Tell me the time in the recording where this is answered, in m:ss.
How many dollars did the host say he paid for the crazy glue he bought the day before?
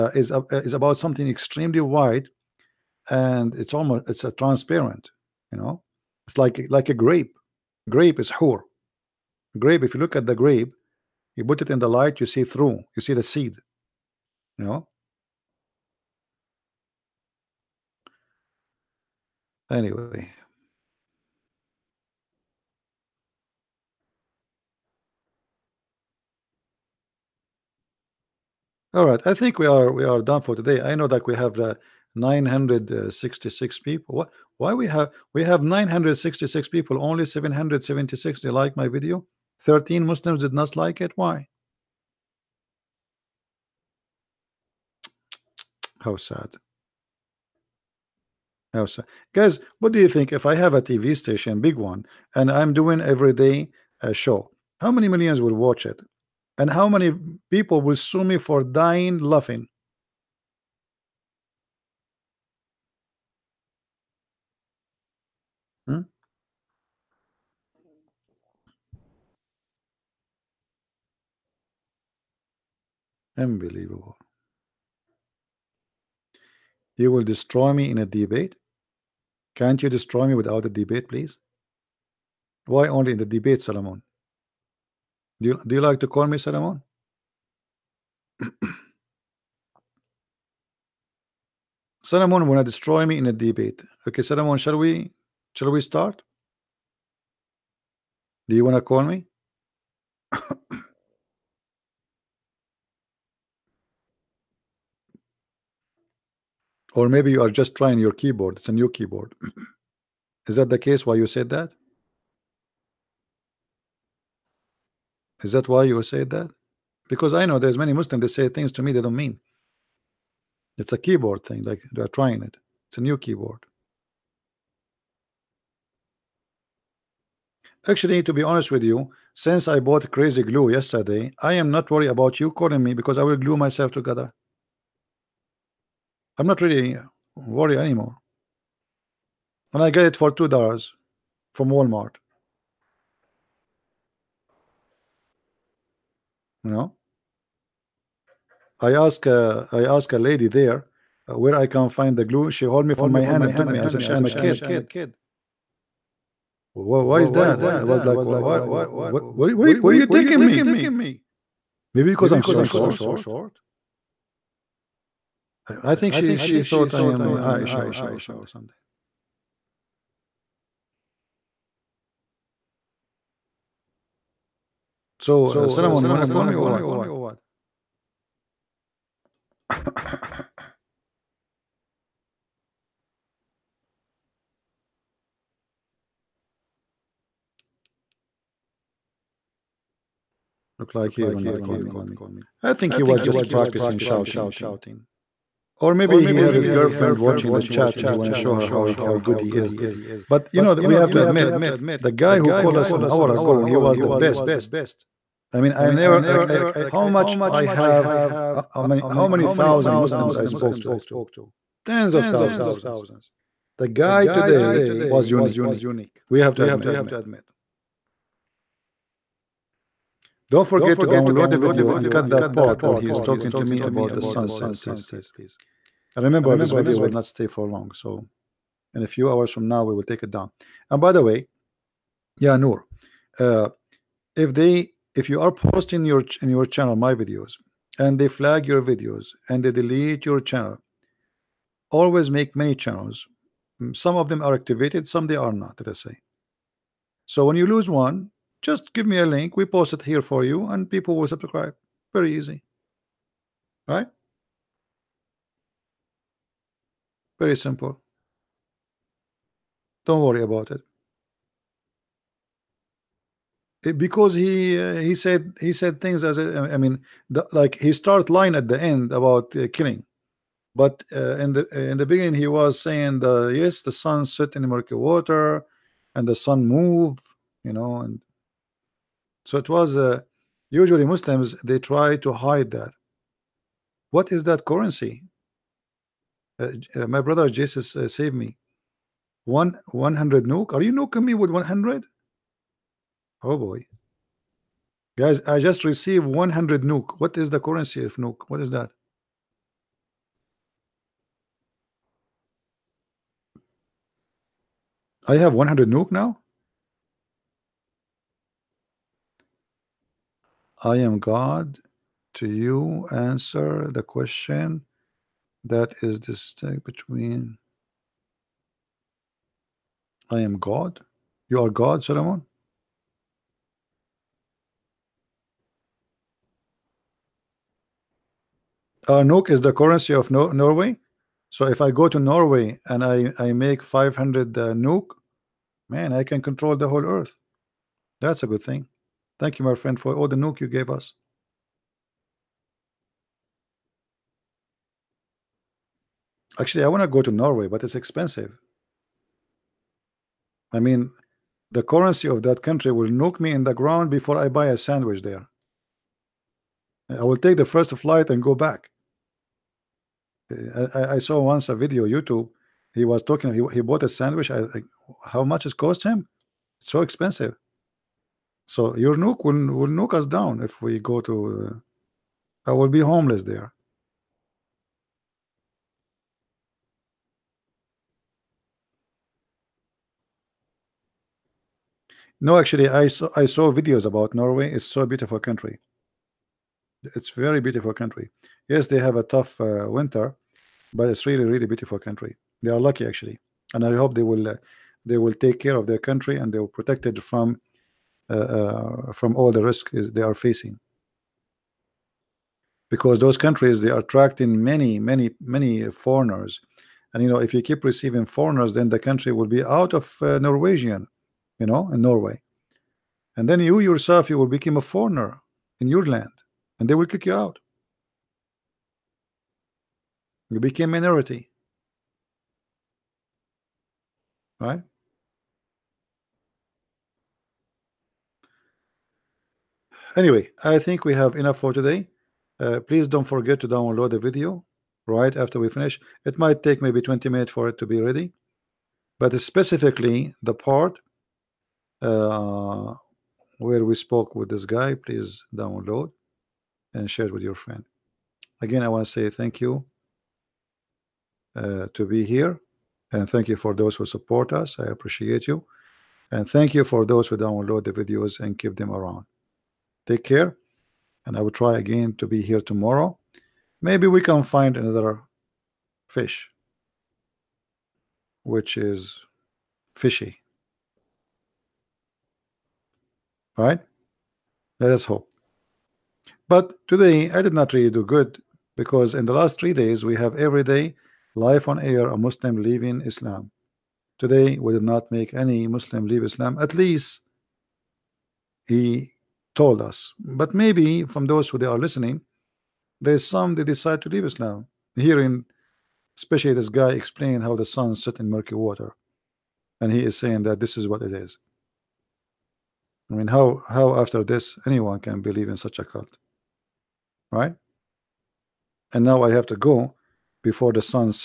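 2:20.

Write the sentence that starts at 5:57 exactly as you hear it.
I will take the first flight and go back.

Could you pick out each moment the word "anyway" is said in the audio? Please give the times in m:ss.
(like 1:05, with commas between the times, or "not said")
0:19, 7:10.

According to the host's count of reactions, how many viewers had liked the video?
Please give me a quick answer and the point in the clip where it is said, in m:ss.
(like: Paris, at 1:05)
776, at 0:37.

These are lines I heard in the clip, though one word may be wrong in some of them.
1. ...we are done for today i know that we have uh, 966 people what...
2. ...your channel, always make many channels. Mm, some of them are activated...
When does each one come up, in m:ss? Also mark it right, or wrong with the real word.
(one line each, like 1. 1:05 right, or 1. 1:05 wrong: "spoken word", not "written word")
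1. 0:29 right
2. 4:00 right.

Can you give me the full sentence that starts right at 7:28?
Again, I want to say thank you uh, to be here.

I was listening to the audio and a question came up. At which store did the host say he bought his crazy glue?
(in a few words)
Walmart.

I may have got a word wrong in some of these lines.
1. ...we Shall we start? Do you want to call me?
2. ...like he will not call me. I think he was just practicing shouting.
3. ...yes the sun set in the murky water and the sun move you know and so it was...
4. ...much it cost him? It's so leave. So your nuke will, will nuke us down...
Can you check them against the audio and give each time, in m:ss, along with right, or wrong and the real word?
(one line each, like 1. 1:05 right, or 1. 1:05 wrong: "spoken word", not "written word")
1. 1:34 right
2. 3:10 right
3. 4:33 right
4. 6:05 wrong: "expensive", not "leave".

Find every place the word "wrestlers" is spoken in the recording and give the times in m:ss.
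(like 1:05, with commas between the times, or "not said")
not said.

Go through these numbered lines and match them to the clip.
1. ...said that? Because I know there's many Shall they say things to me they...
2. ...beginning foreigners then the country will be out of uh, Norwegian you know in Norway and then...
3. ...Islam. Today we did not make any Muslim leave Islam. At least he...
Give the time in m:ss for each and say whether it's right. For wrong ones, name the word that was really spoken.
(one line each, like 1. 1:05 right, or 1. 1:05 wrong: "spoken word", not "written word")
1. 1:56 wrong: "Muslims", not "Shall"
2. 6:47 wrong: "receiving", not "beginning"
3. 8:03 right.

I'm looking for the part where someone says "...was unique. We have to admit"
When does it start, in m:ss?
3:35.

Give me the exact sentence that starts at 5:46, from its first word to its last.
Actually, I want to go to Norway, but it's expensive.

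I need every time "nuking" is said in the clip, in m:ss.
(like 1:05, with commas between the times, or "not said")
4:50.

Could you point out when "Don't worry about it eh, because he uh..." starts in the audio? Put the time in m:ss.
4:20.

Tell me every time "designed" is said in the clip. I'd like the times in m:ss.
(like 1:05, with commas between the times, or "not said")
not said.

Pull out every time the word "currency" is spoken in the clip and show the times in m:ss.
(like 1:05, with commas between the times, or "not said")
4:44, 4:57, 5:29, 5:51.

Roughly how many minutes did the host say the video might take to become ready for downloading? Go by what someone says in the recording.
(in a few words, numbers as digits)
20.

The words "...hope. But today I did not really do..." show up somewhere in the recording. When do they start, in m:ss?
7:55.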